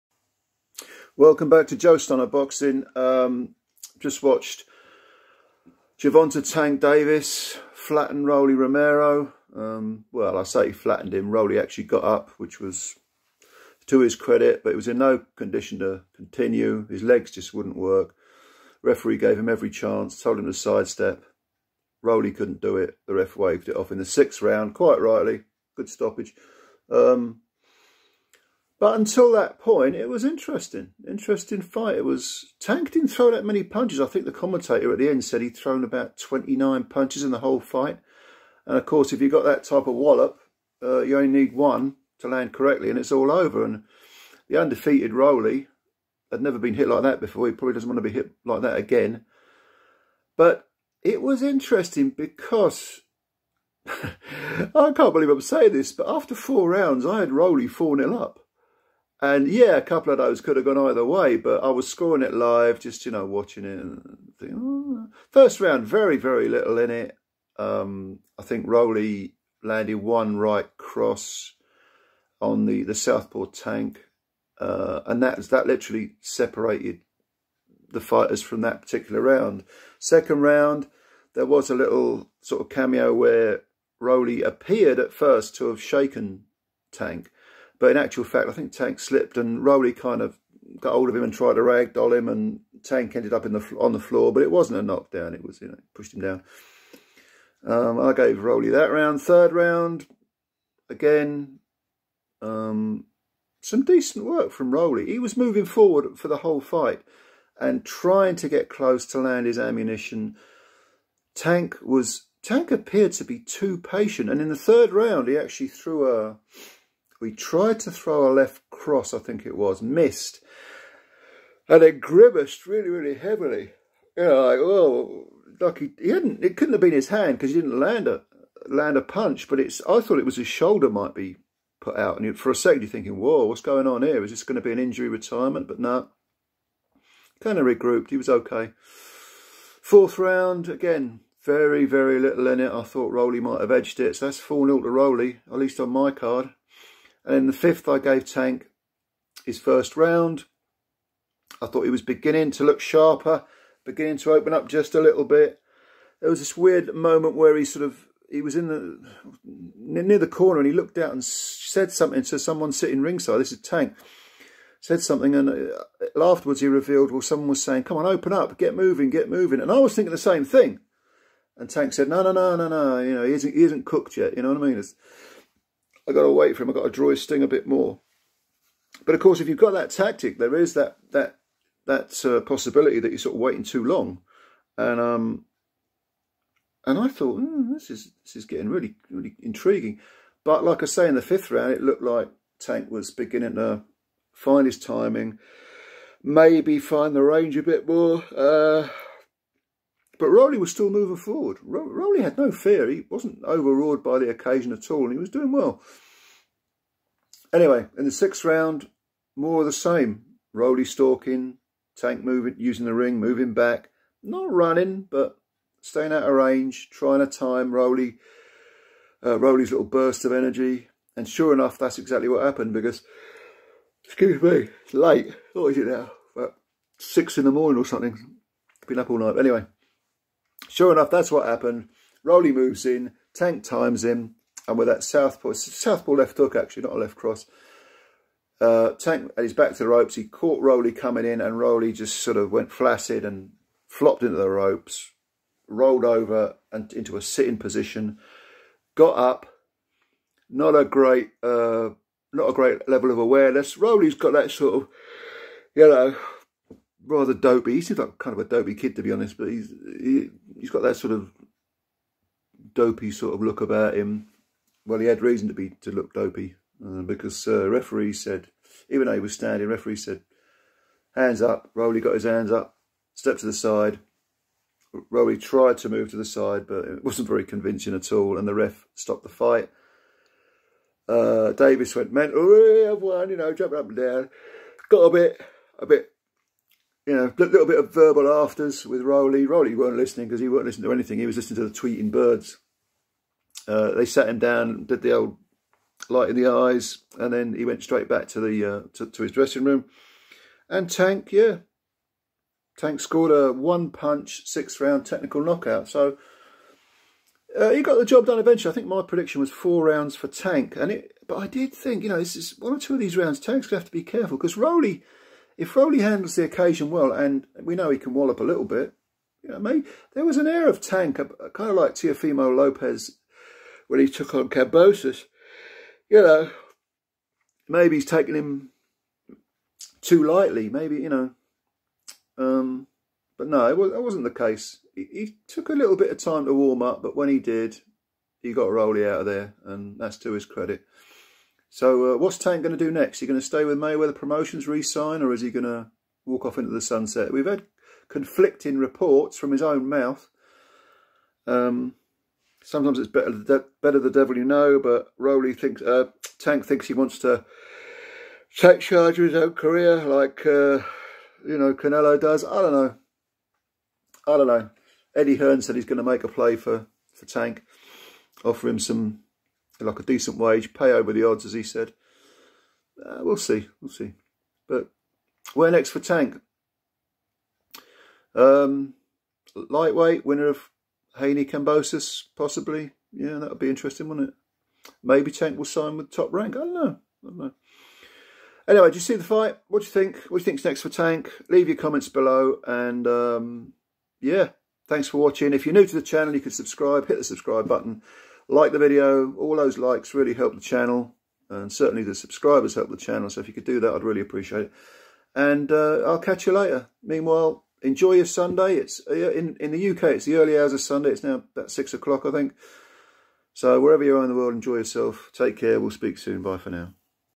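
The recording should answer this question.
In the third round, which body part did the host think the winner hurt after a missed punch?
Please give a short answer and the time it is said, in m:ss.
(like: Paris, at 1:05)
shoulder, at 2:10.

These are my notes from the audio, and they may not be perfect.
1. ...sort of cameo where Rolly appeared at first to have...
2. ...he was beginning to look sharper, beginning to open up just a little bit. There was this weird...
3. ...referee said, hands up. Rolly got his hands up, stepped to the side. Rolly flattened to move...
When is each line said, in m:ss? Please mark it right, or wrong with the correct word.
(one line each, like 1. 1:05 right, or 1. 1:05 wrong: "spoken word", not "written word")
1. 1:22 right
2. 2:31 right
3. 4:29 wrong: "tried", not "flattened".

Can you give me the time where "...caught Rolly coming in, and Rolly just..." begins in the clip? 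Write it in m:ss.
4:00.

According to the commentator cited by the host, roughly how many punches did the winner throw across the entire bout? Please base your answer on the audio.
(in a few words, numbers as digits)
29.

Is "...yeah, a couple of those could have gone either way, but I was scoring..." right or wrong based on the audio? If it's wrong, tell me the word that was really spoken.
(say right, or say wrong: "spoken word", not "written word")
right.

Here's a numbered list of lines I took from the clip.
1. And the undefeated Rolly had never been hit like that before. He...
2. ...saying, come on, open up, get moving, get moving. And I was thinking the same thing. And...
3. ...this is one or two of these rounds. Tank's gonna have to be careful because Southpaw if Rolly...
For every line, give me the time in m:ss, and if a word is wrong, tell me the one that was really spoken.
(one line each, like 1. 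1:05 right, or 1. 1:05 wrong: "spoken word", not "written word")
1. 0:43 right
2. 2:47 right
3. 5:12 wrong: "Rolly", not "Southpaw".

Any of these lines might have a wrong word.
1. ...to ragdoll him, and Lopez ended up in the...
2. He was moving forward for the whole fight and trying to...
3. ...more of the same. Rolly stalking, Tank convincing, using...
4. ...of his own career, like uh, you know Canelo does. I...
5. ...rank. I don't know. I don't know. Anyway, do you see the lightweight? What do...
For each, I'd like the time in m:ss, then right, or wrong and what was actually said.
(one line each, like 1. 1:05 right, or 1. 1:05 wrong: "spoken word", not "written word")
1. 1:31 wrong: "Tank", not "Lopez"
2. 1:45 right
3. 3:29 wrong: "moving", not "convincing"
4. 5:59 right
5. 6:26 wrong: "fight", not "lightweight".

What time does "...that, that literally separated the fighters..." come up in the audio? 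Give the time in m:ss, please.
1:15.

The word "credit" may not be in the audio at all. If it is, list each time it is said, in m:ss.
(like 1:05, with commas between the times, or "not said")
0:14, 5:40.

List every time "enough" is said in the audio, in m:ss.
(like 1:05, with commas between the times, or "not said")
3:41, 3:50.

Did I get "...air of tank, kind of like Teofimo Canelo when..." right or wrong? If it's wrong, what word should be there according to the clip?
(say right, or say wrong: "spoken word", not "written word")
wrong: "Lopez", not "Canelo".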